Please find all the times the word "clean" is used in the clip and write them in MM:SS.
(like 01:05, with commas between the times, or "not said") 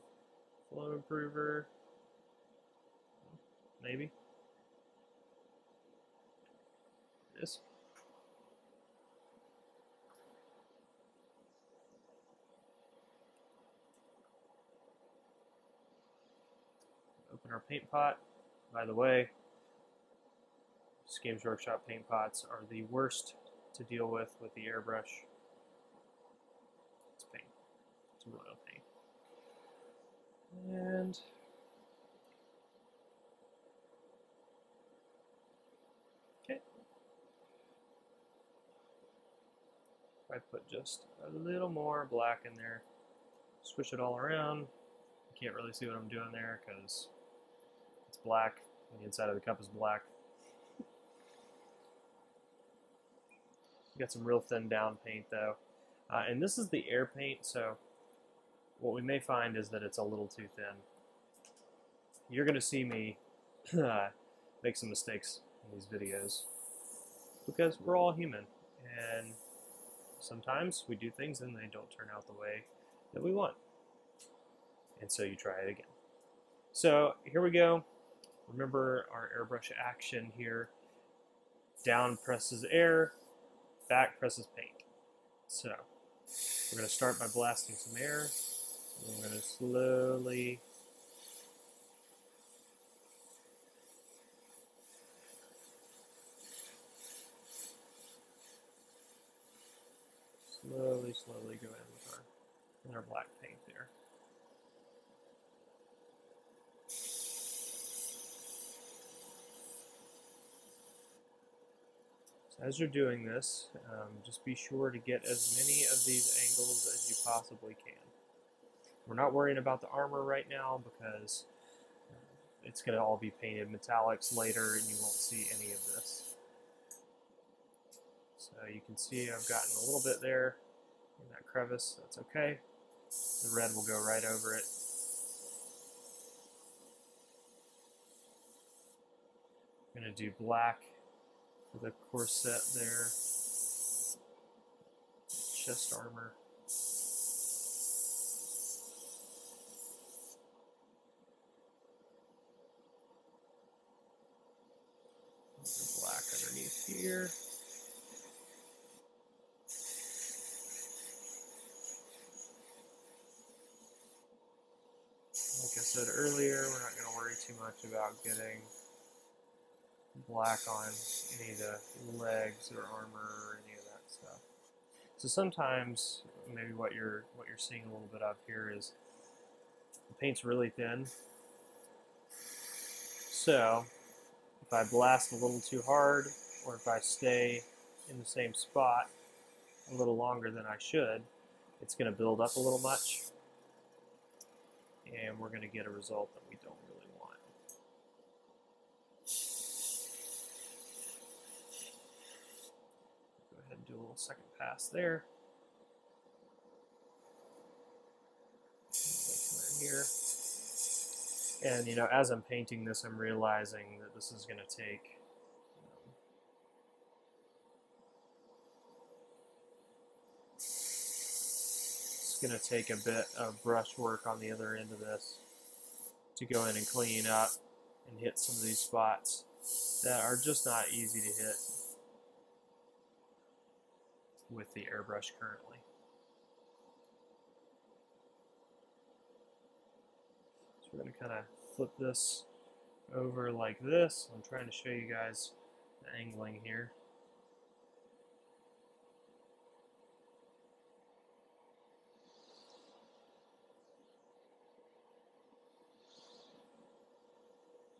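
03:46.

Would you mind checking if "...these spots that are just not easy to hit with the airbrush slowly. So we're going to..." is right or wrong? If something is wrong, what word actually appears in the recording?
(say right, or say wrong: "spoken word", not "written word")
wrong: "currently", not "slowly".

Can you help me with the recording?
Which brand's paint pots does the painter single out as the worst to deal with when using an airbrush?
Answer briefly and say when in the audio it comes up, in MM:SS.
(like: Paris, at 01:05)
Games Workshop, at 00:21.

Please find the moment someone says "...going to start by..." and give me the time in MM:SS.
01:26.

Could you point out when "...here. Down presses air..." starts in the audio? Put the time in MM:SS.
01:20.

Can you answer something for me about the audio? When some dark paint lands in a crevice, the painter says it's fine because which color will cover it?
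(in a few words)
Red.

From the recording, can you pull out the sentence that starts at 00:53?
got some real thin down paint though.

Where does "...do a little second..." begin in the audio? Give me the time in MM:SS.
03:23.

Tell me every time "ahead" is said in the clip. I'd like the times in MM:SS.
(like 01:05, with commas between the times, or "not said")
03:23.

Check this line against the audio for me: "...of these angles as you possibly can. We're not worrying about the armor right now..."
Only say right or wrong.
right.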